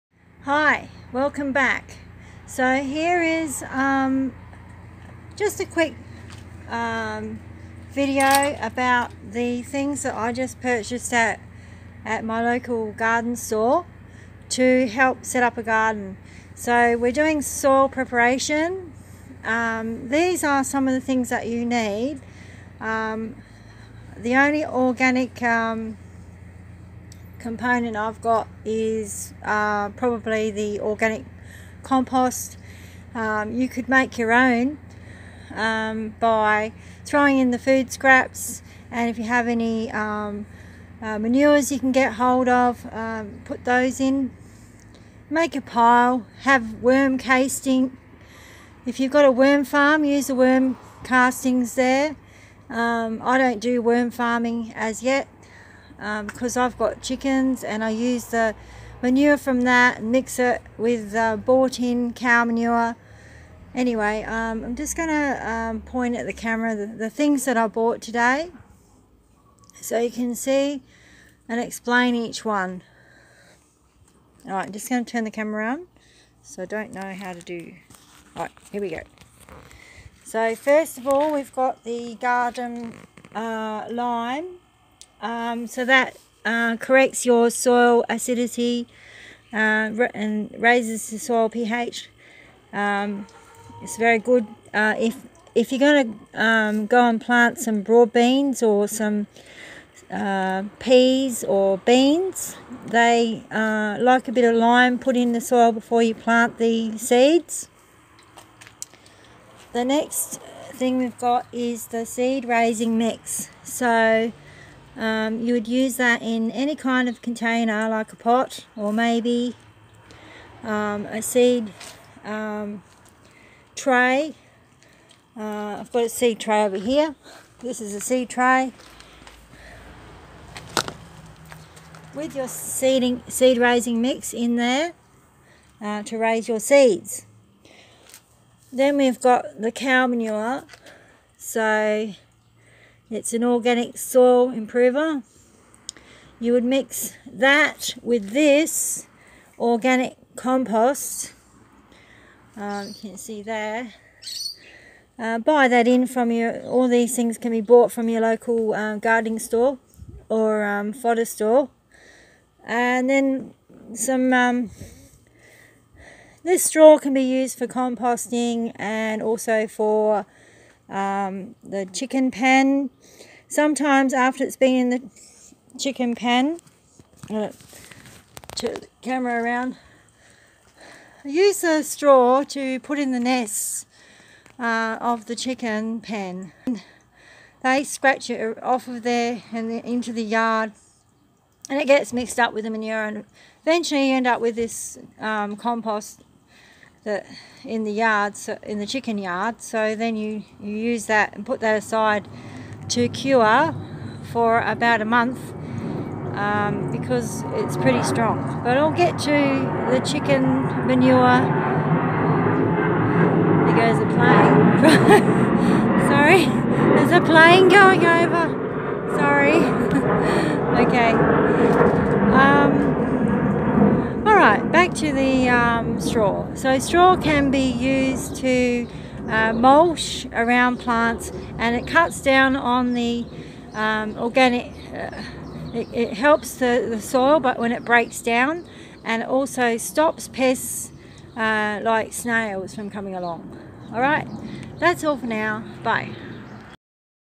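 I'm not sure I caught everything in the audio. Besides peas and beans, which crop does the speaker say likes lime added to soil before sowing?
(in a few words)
Broad beans.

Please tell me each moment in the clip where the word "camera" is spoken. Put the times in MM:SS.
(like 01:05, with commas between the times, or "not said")
01:06, 01:15, 02:59.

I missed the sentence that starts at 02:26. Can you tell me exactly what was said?
You would mix that with this organic compost.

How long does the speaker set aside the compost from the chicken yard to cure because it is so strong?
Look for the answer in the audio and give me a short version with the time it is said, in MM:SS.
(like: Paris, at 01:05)
About a month, at 03:24.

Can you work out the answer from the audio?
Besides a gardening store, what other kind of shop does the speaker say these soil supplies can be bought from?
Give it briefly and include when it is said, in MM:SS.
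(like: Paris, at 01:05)
Fodder store, at 02:40.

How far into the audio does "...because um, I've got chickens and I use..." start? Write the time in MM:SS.
00:56.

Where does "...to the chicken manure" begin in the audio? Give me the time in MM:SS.
03:29.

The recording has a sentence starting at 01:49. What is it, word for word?
The next thing we've got is the seed raising mix.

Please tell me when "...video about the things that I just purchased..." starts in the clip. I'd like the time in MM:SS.
00:07.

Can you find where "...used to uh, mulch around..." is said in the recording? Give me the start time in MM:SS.
03:47.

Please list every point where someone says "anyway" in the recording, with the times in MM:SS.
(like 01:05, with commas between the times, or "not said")
01:03.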